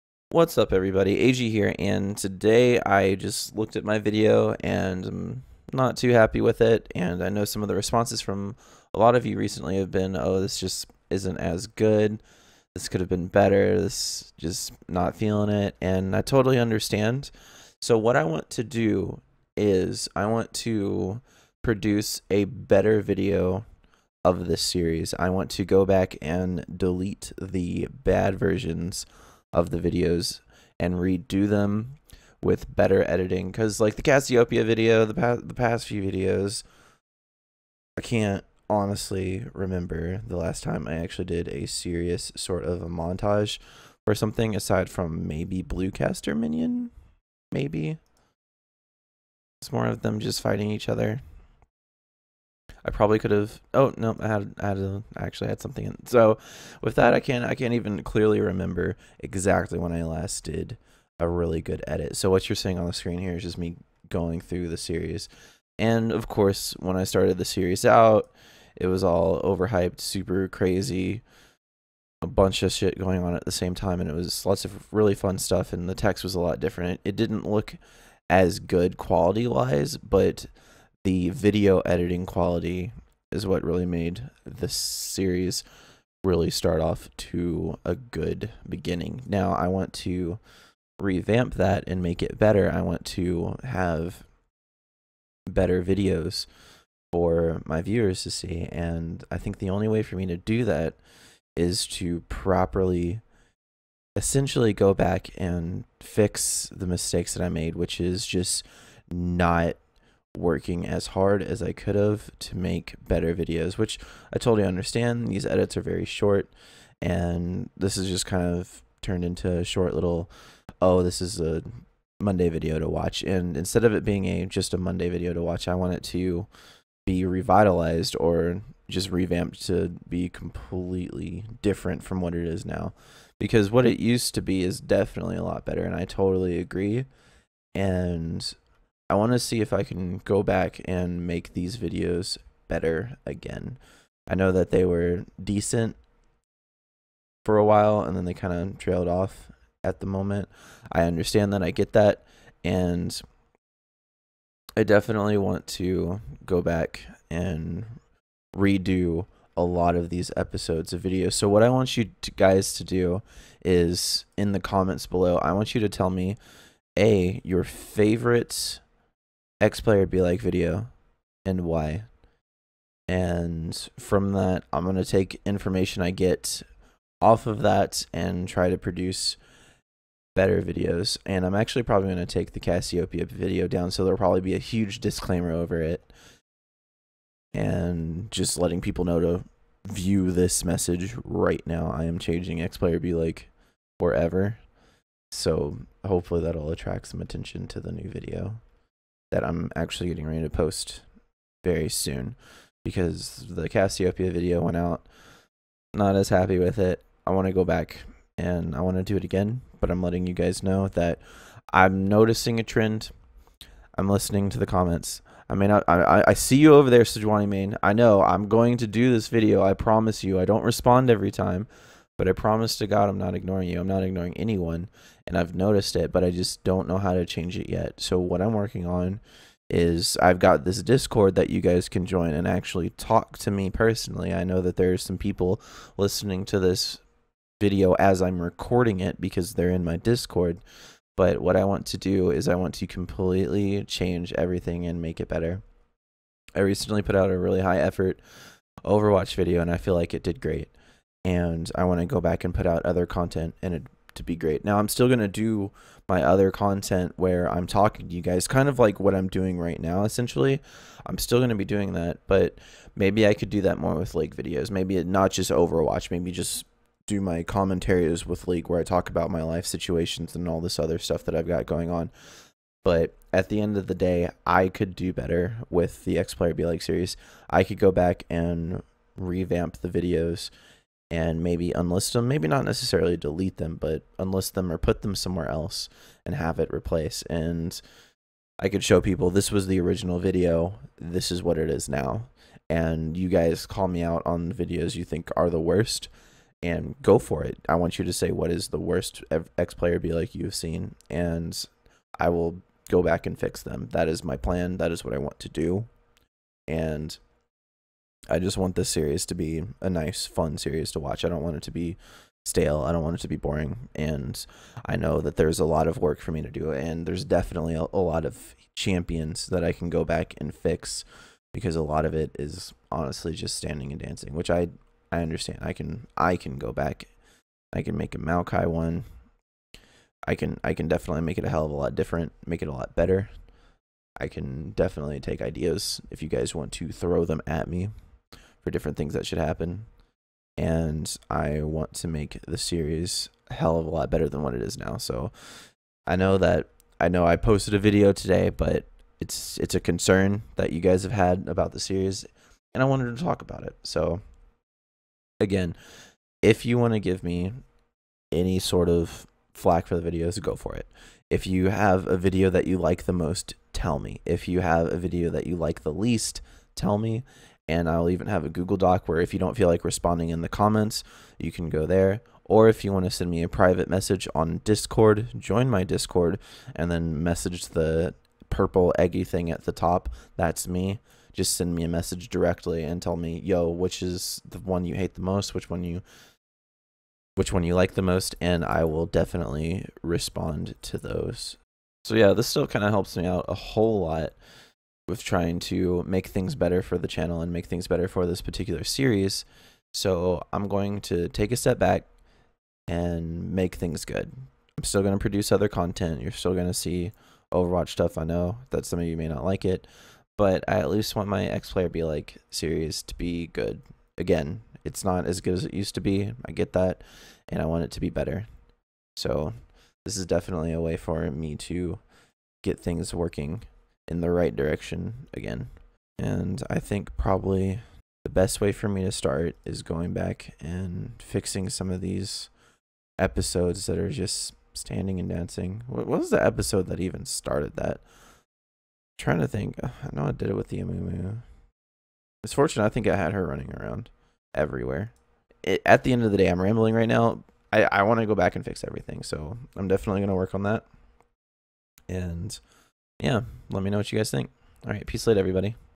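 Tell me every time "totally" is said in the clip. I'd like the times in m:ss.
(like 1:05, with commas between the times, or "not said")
0:16, 1:54, 2:16.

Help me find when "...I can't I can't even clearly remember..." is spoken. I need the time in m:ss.
0:57.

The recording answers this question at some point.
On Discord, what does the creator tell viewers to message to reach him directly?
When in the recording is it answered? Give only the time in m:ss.
6:18.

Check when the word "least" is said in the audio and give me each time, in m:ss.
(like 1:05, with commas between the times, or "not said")
6:05, 6:50.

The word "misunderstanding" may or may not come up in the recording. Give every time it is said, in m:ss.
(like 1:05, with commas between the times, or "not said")
not said.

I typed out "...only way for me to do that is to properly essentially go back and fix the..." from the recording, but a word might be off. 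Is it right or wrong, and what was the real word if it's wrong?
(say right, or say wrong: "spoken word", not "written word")
right.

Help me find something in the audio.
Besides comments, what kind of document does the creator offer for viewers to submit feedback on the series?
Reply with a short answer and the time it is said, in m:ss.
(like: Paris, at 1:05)
Google Doc, at 6:08.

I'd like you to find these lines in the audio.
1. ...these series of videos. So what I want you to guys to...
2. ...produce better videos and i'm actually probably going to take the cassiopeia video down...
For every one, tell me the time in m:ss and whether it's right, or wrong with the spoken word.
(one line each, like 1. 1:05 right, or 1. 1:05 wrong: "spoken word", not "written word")
1. 2:40 wrong: "episodes", not "series"
2. 2:58 right.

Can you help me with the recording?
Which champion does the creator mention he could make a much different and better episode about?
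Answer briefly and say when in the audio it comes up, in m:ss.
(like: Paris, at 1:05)
Maokai, at 5:28.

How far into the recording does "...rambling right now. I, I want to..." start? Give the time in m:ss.
7:26.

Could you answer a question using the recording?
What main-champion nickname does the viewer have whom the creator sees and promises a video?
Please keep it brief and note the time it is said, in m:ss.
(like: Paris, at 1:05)
Sejuani Main, at 3:37.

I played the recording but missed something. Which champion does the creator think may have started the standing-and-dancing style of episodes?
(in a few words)
Amumu.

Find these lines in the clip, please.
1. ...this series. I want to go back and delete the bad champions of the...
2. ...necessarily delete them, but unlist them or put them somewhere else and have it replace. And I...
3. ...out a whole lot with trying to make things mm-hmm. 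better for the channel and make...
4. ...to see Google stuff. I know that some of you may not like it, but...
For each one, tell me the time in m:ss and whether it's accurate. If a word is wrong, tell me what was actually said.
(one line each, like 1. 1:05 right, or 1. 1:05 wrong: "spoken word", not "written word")
1. 0:24 wrong: "versions", not "champions"
2. 4:42 right
3. 6:33 right
4. 6:46 wrong: "Overwatch", not "Google".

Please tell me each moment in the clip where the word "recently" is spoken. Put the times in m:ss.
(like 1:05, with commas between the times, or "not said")
0:09, 4:06.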